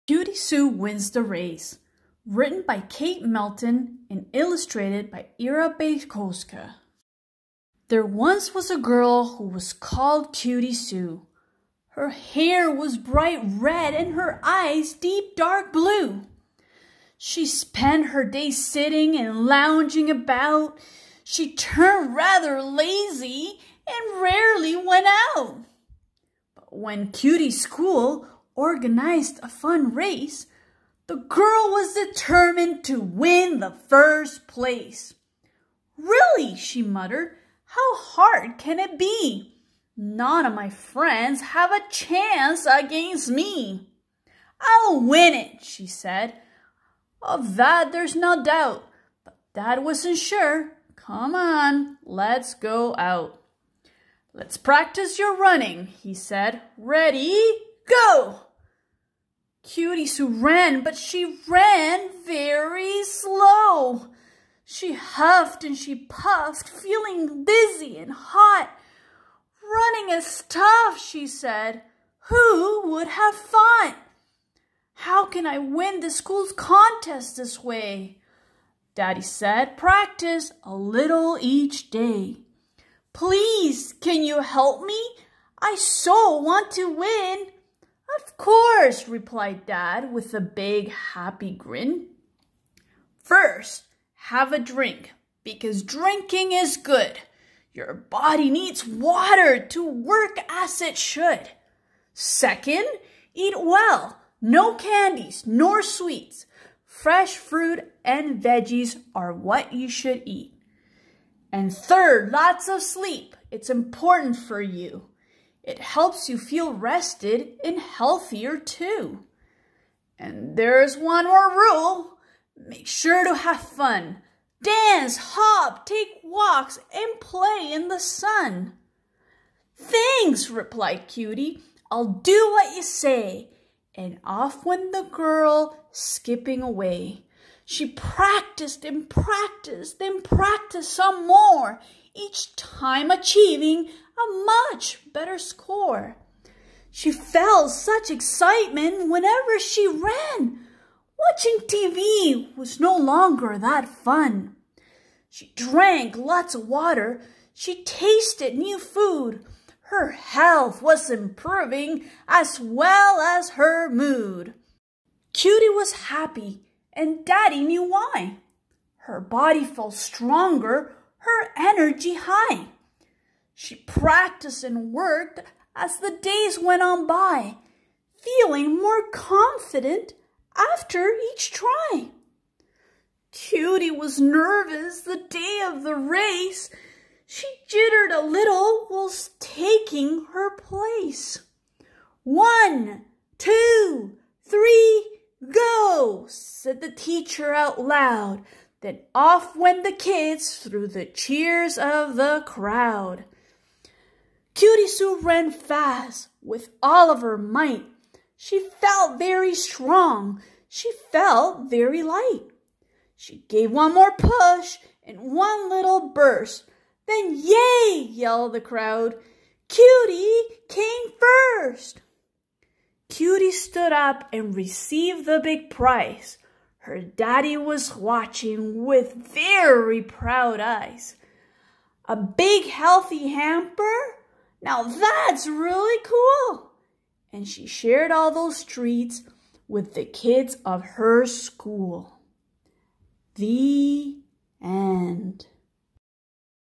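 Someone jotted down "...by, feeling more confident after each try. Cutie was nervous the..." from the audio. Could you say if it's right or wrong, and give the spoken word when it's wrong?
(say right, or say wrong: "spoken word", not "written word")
right.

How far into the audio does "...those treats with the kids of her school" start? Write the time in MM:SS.
03:58.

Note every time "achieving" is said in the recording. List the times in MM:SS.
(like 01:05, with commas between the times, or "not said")
02:23.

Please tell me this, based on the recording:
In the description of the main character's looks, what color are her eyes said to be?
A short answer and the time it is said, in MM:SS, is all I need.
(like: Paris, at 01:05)
deep dark blue, at 00:14.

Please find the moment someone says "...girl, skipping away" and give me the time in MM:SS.
02:15.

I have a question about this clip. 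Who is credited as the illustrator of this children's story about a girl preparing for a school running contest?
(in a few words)
Ira Bajkowska.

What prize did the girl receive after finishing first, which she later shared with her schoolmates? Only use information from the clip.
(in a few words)
a big healthy hamper.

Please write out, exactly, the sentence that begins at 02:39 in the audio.
Her health was improving as well as her mood.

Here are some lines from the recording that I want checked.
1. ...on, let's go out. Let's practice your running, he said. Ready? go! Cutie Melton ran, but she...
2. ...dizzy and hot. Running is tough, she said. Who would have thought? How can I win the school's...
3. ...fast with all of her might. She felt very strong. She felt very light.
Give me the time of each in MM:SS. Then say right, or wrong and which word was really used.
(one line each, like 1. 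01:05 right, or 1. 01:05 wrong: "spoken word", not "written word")
1. 00:51 wrong: "Sue", not "Melton"
2. 01:07 right
3. 03:25 right.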